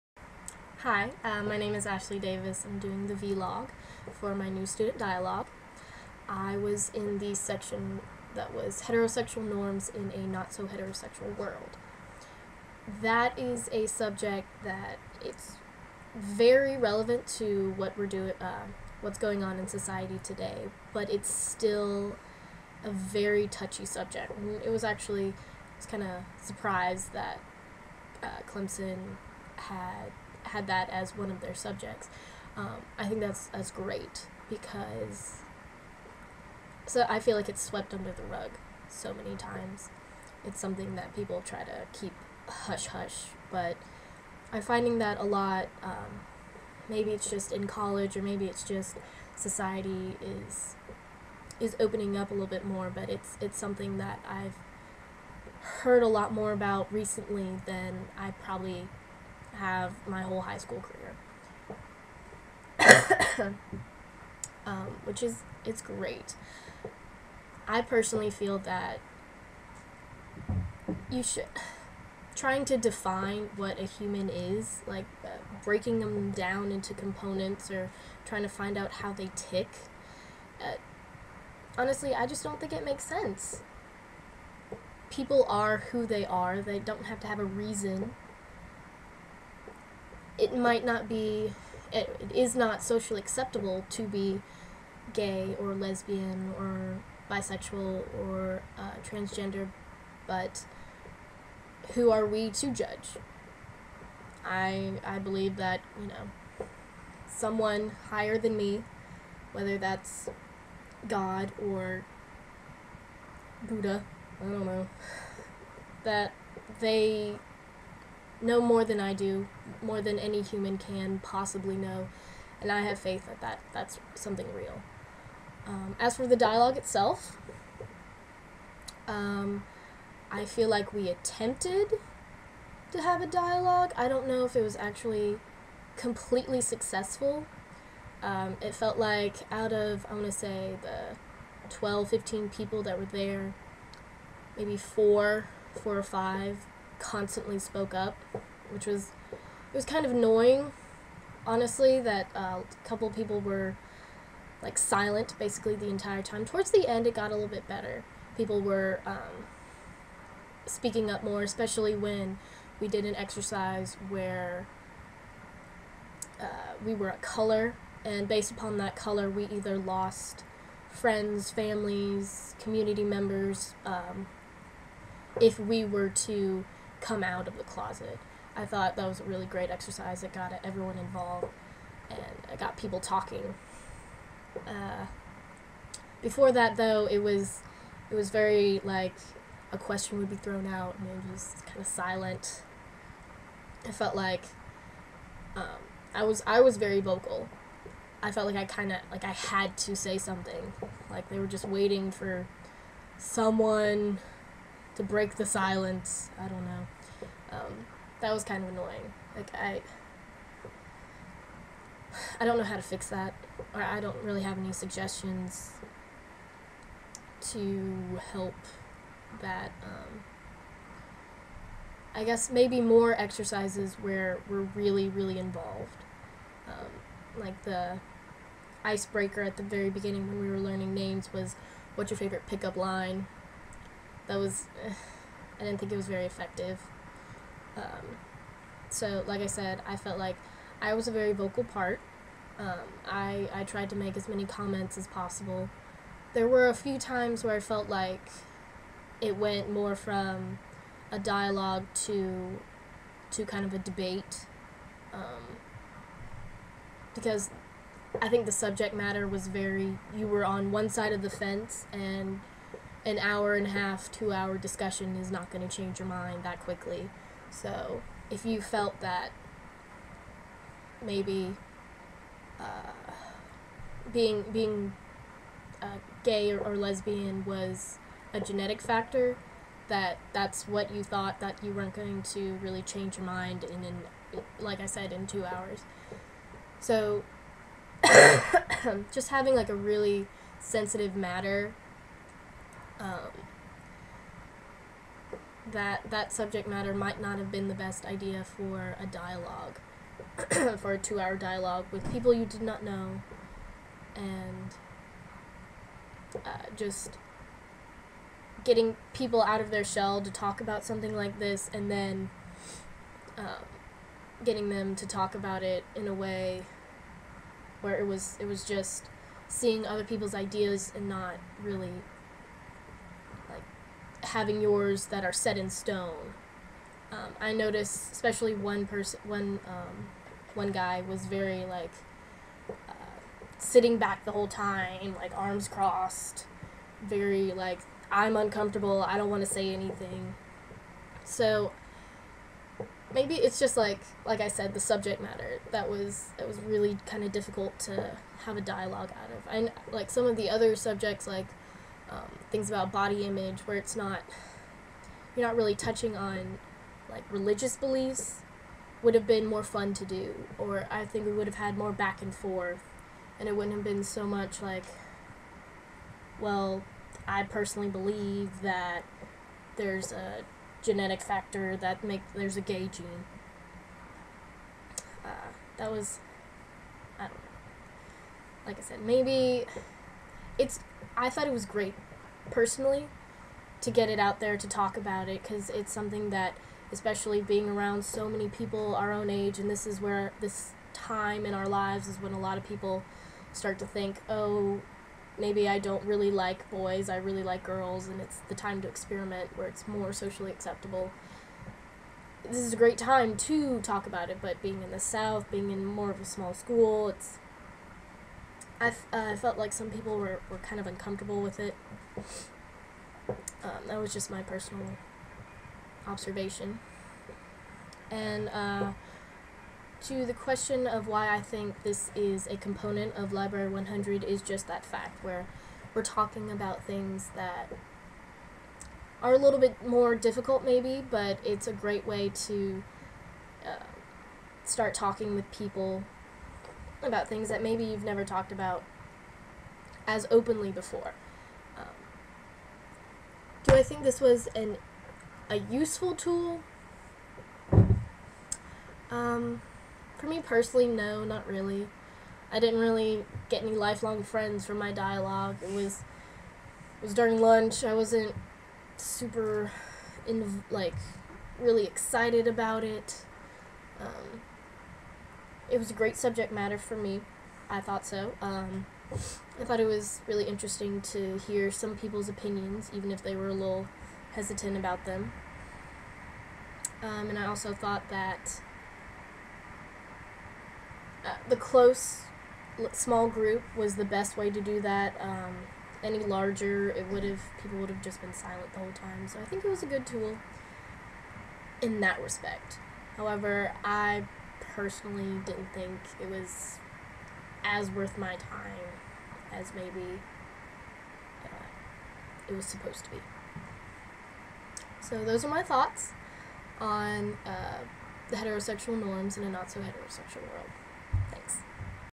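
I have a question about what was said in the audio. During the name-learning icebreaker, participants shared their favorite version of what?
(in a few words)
Pickup line.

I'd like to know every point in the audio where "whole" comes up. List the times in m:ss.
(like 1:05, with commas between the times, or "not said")
1:00, 5:34, 8:08.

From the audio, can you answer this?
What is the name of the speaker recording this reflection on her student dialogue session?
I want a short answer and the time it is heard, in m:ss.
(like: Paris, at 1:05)
Ashley Davis, at 0:01.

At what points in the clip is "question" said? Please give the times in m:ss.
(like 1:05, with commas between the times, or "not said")
3:09, 7:00.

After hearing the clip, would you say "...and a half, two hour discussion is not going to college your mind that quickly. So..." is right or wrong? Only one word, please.
wrong.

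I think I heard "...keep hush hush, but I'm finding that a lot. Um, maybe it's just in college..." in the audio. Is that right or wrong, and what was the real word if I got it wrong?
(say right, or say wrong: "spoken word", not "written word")
right.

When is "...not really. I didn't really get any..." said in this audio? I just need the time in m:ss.
7:31.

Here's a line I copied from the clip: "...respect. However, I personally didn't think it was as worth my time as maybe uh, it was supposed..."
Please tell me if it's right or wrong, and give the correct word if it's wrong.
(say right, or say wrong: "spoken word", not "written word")
right.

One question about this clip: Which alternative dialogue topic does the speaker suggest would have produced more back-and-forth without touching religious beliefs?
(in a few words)
Body image.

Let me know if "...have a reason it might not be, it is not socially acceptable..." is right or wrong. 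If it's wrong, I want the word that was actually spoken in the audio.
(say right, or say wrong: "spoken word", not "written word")
right.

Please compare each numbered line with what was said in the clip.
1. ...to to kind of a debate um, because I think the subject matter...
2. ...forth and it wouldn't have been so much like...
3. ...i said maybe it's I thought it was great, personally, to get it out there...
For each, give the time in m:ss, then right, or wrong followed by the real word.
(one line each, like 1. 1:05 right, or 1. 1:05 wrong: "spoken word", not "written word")
1. 4:11 right
2. 6:02 right
3. 6:18 right.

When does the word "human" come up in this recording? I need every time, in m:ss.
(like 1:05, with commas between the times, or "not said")
1:13, 2:00.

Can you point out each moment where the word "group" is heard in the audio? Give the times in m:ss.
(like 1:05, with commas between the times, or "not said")
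8:03.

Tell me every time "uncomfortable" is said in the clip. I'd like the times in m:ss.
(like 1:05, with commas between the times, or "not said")
5:38, 6:50.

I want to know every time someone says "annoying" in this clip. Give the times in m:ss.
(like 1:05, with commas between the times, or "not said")
2:30, 3:28.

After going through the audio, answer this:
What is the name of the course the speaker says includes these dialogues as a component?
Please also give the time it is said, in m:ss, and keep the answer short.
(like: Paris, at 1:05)
Library 100, at 7:03.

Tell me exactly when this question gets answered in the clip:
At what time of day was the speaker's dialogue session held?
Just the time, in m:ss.
7:37.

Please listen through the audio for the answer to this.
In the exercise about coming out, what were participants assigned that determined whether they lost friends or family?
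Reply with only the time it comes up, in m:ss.
2:47.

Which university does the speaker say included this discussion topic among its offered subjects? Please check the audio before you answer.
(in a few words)
Clemson.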